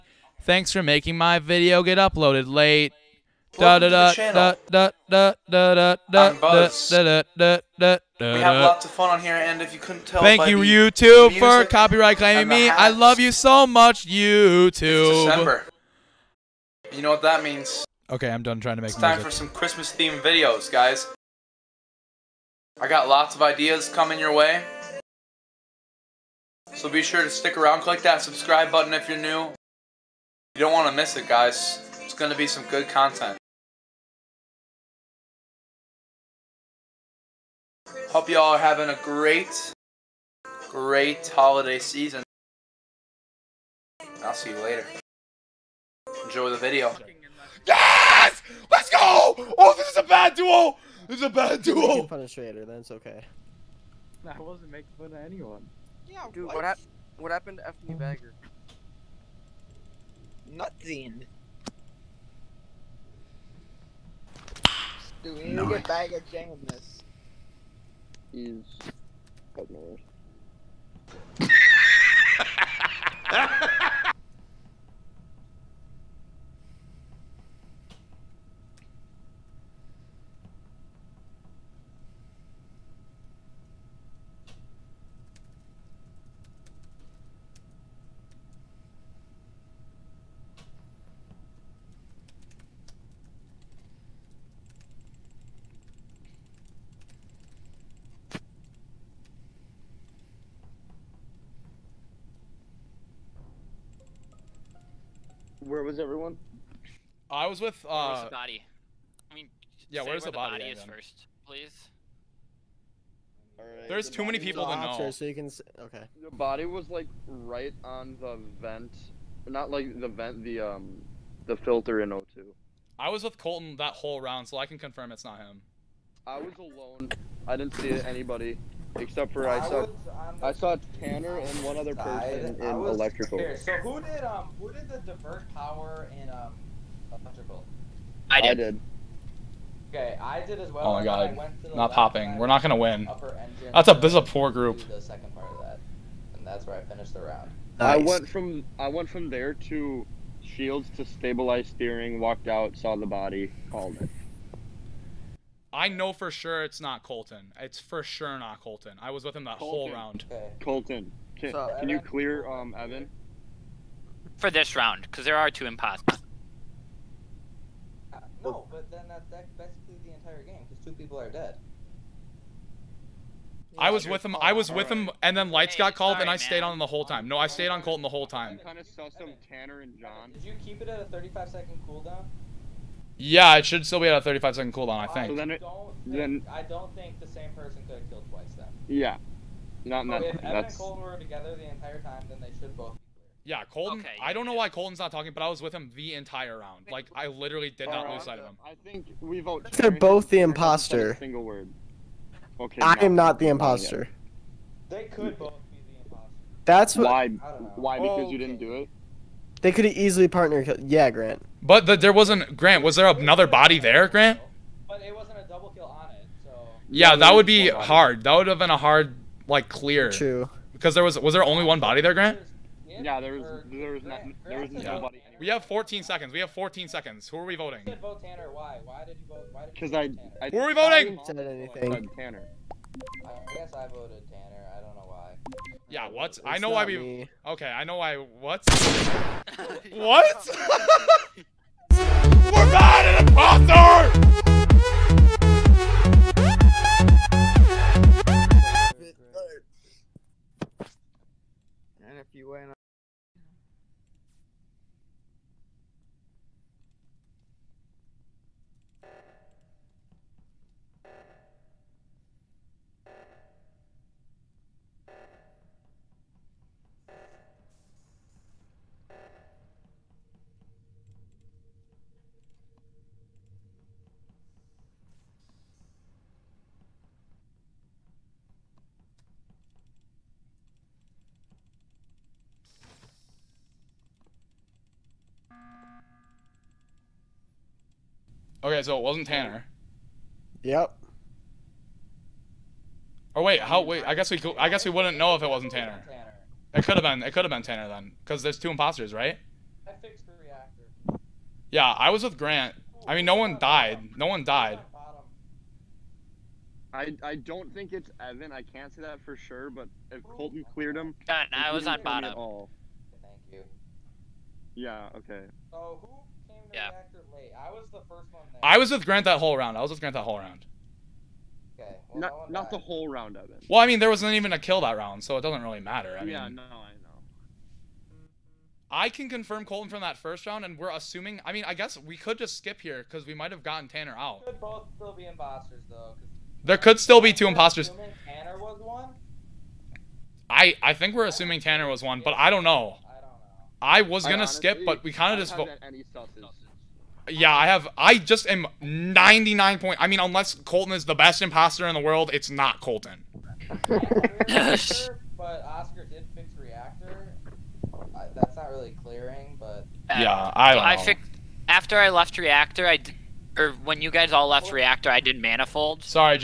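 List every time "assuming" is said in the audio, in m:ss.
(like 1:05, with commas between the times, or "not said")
5:30, 5:41.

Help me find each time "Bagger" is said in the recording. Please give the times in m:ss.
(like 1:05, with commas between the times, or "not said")
0:57, 1:05.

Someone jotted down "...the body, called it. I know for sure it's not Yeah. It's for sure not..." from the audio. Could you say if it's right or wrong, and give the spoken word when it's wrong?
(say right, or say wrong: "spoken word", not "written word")
wrong: "Colton", not "Yeah".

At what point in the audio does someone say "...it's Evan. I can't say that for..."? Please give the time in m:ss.
5:07.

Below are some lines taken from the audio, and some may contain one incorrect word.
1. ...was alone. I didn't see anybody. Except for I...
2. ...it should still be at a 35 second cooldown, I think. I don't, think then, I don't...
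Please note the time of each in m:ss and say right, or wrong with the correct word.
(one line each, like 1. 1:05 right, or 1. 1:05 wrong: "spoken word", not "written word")
1. 2:06 right
2. 3:03 right.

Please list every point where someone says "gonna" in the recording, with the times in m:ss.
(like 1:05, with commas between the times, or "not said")
2:22, 5:44.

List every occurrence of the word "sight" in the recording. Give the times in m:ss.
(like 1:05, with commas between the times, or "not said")
3:18.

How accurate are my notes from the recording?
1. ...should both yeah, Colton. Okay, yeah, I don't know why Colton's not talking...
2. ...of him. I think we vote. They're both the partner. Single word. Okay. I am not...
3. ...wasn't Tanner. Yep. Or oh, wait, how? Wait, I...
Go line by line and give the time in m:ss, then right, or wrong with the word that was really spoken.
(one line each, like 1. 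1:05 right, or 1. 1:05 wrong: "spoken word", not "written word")
1. 3:12 right
2. 3:18 wrong: "imposter", not "partner"
3. 4:49 right.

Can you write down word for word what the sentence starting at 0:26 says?
So be sure to stick around, click that subscribe button if you're new.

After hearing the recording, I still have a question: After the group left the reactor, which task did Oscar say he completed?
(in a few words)
manifold.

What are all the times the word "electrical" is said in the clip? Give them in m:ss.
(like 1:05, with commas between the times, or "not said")
2:12, 2:17.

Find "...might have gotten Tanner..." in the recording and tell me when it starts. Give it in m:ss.
5:33.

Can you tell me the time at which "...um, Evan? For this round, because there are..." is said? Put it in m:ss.
2:42.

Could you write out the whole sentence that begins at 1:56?
The body was like right on the vent, not like the vent, the um, the filter in O2.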